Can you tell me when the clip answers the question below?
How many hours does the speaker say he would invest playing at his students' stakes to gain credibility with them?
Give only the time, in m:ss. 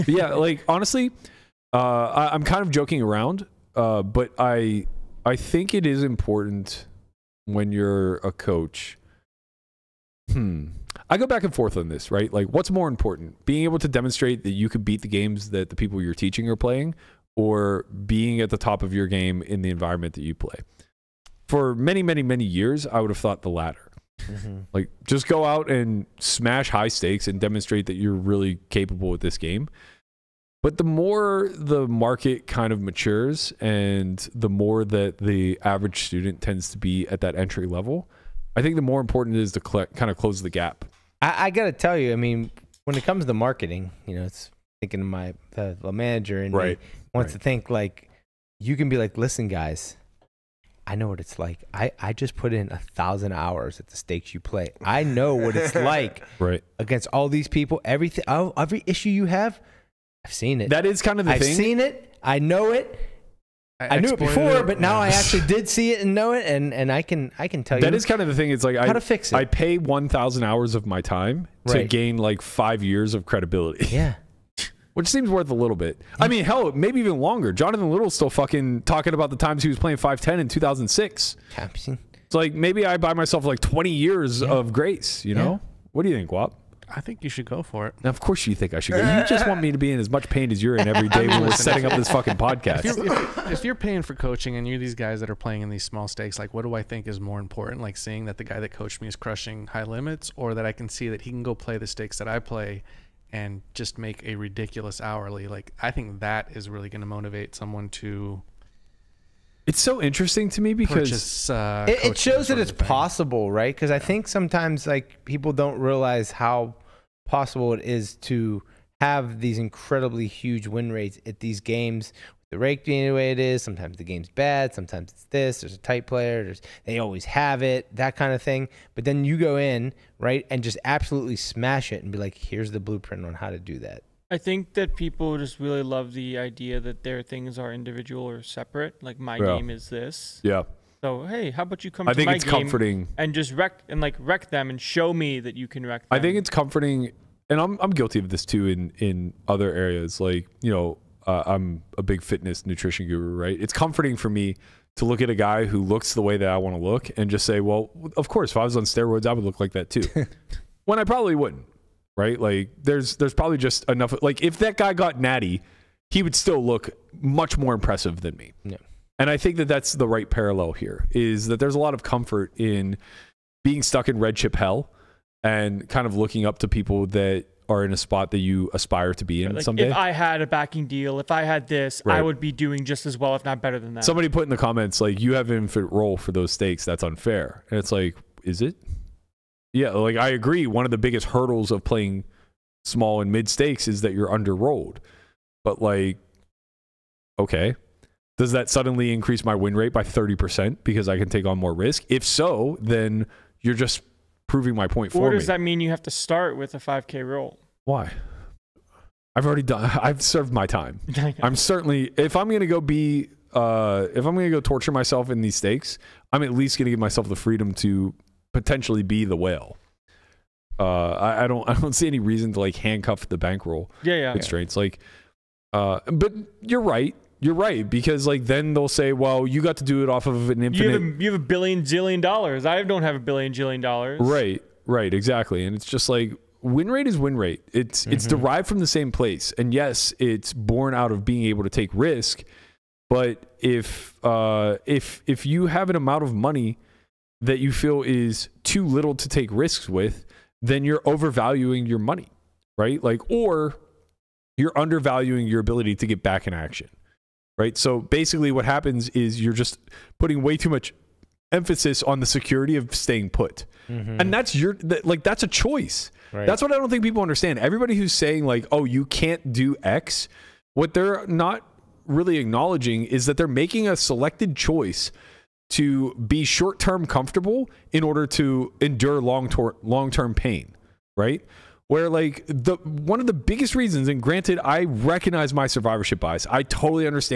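0:52.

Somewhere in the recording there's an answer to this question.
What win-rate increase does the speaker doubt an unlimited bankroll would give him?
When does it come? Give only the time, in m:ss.
3:20.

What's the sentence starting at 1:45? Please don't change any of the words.
Like I think that is really going to motivate someone to.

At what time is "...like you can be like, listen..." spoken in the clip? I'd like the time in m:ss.
0:47.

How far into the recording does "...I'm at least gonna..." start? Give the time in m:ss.
3:36.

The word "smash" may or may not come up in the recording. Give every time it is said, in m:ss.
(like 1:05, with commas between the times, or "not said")
0:26, 2:11.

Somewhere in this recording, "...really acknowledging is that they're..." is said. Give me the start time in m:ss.
4:32.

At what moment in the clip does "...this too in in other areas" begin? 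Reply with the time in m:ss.
2:28.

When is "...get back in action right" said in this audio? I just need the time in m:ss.
4:16.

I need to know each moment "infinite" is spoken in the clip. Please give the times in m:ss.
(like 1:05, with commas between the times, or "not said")
3:05, 3:50.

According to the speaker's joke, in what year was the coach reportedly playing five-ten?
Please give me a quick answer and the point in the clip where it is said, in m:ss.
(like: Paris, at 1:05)
2006, at 1:20.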